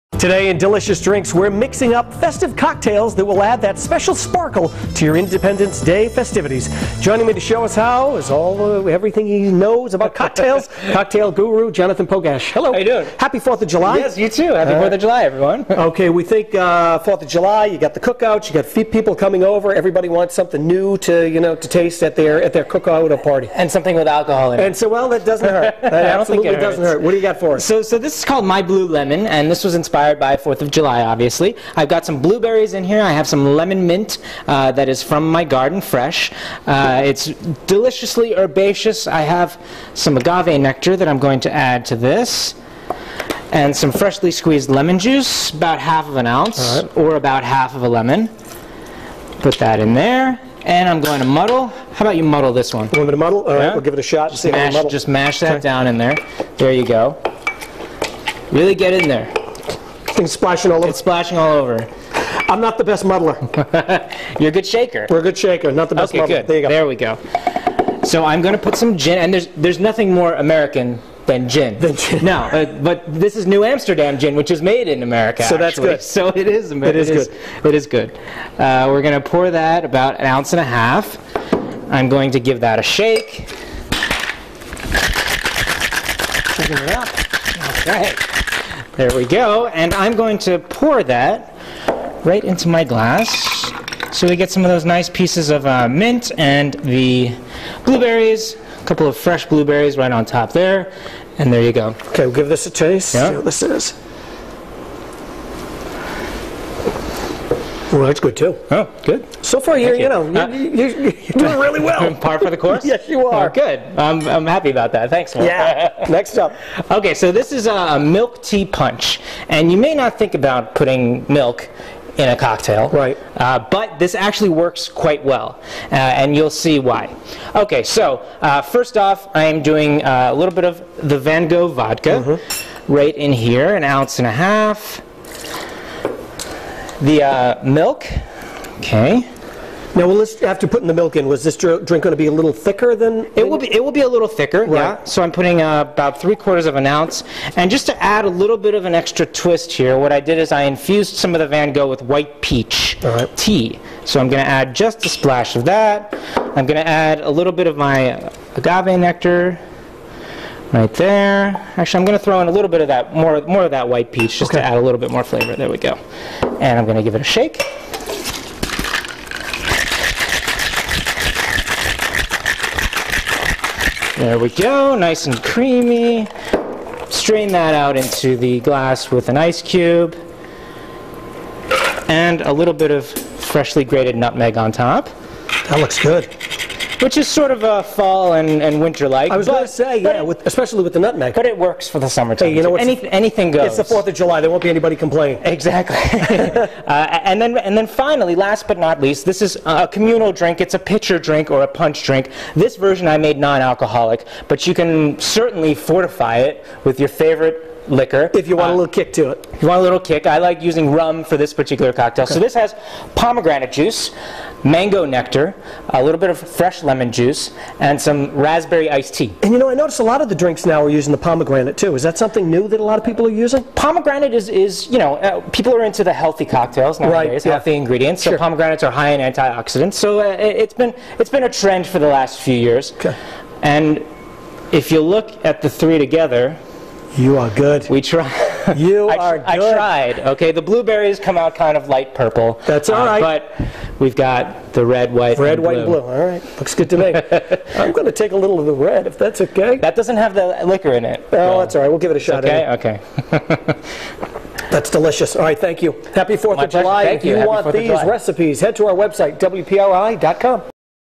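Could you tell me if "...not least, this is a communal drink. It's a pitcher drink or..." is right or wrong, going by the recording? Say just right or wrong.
right.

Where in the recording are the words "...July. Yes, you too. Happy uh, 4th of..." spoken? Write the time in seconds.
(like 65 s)
13 s.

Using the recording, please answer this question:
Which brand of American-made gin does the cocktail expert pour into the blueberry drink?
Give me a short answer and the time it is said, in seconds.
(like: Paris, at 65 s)
New Amsterdam, at 73 s.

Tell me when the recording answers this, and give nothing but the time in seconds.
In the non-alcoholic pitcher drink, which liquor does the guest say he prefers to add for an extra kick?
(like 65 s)
210 s.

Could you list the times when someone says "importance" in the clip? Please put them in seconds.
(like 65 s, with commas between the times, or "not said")
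not said.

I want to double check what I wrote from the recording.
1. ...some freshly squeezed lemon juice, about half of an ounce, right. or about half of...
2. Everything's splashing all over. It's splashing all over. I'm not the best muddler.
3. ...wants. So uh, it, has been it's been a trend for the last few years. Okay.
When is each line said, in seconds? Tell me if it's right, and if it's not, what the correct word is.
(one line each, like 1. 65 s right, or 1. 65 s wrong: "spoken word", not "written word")
1. 43 s right
2. 60 s right
3. 229 s wrong: "antioxidants", not "wants".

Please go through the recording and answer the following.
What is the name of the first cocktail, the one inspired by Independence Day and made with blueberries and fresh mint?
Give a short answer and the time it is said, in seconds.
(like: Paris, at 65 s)
My Blue Lemon, at 28 s.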